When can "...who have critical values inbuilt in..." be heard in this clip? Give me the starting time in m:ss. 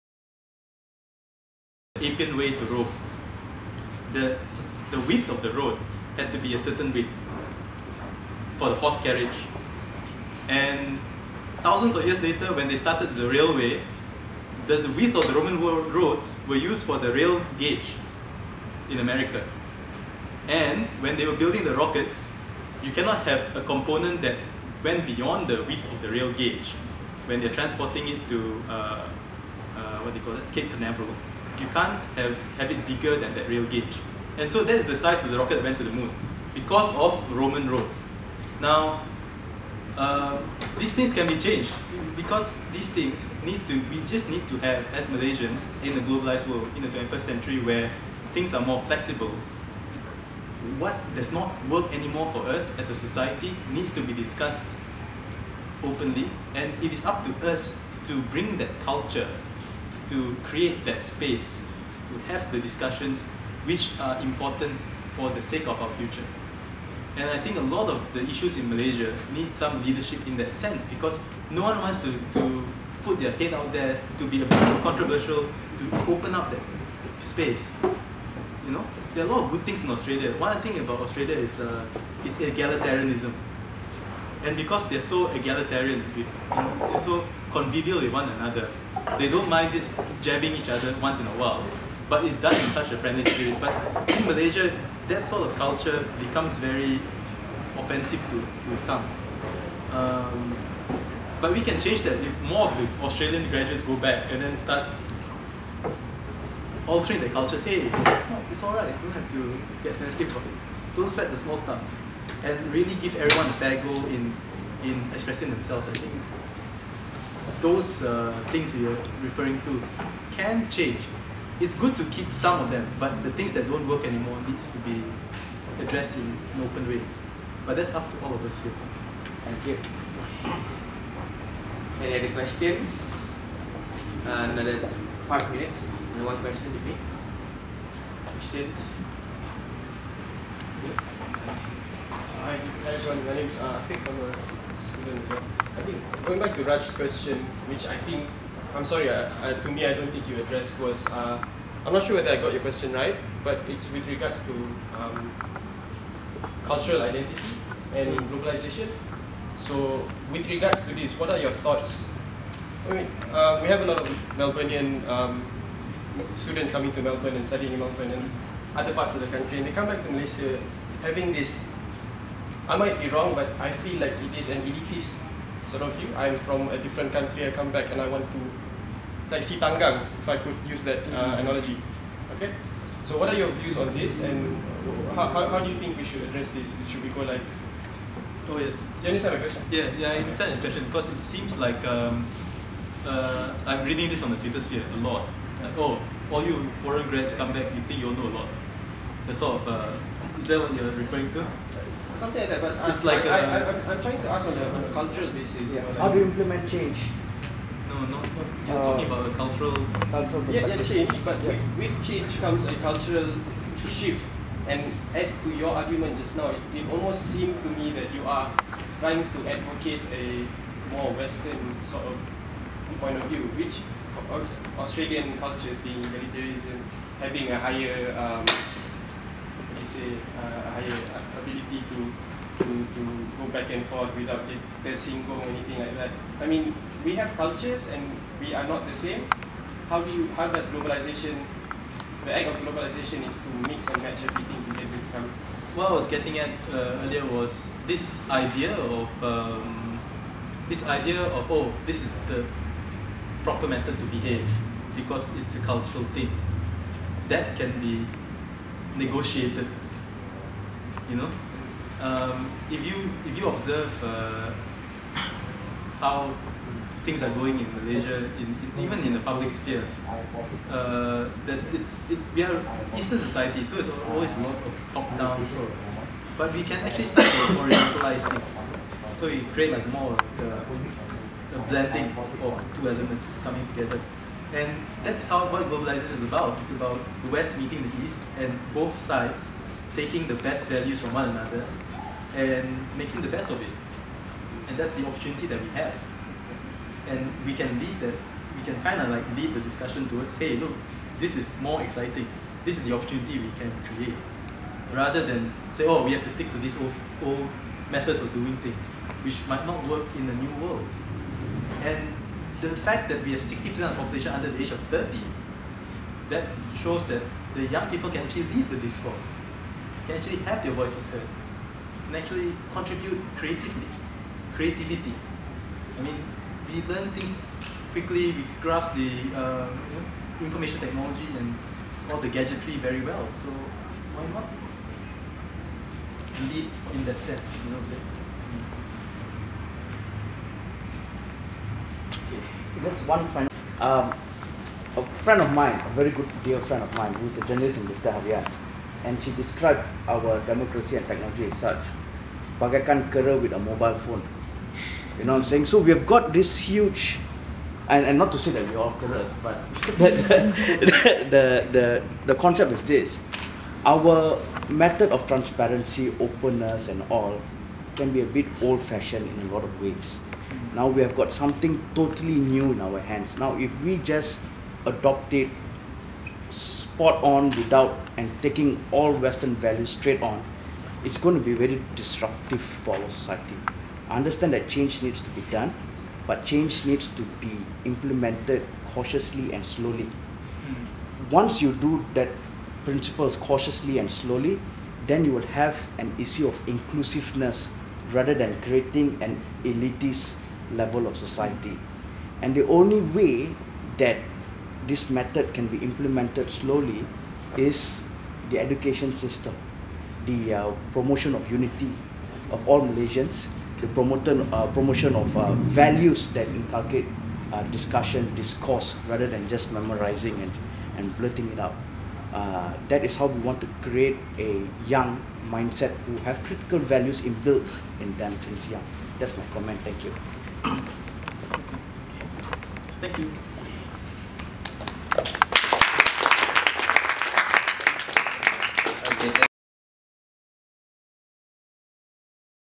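7:06.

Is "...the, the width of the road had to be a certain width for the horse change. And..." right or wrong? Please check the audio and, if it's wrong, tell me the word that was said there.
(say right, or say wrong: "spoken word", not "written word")
wrong: "carriage", not "change".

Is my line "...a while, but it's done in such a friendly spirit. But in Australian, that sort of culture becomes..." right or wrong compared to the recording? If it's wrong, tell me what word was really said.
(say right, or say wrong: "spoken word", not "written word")
wrong: "Malaysia", not "Australian".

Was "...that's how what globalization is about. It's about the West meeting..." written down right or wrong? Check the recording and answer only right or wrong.
right.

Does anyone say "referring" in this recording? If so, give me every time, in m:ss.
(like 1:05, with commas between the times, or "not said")
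1:59, 3:20.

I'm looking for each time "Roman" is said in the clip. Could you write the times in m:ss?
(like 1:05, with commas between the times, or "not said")
0:15, 0:37.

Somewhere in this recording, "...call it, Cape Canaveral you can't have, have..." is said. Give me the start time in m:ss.
0:30.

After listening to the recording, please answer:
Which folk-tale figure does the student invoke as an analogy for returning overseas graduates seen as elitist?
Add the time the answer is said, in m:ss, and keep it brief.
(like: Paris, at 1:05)
Si Tanggang, at 2:59.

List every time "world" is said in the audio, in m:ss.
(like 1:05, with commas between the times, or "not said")
0:46, 5:10.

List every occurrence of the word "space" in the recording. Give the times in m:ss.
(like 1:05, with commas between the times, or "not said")
1:00, 1:17.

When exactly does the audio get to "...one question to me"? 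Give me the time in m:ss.
2:16.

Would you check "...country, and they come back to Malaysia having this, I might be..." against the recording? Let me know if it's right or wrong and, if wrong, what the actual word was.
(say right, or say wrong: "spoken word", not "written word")
right.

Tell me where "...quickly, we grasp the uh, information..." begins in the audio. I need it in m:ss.
5:27.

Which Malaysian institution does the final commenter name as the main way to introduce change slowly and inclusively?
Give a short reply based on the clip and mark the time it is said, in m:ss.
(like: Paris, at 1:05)
The education system, at 6:48.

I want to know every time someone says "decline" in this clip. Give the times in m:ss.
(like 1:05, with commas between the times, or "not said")
not said.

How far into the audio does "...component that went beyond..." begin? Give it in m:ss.
0:23.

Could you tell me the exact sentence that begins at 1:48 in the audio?
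You don't have to get sensitive about it.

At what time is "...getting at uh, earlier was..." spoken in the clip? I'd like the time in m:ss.
4:06.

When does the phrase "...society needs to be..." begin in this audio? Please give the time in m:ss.
0:52.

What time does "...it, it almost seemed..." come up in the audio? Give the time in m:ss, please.
3:36.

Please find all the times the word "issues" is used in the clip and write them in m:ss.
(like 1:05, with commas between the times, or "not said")
1:08, 6:36.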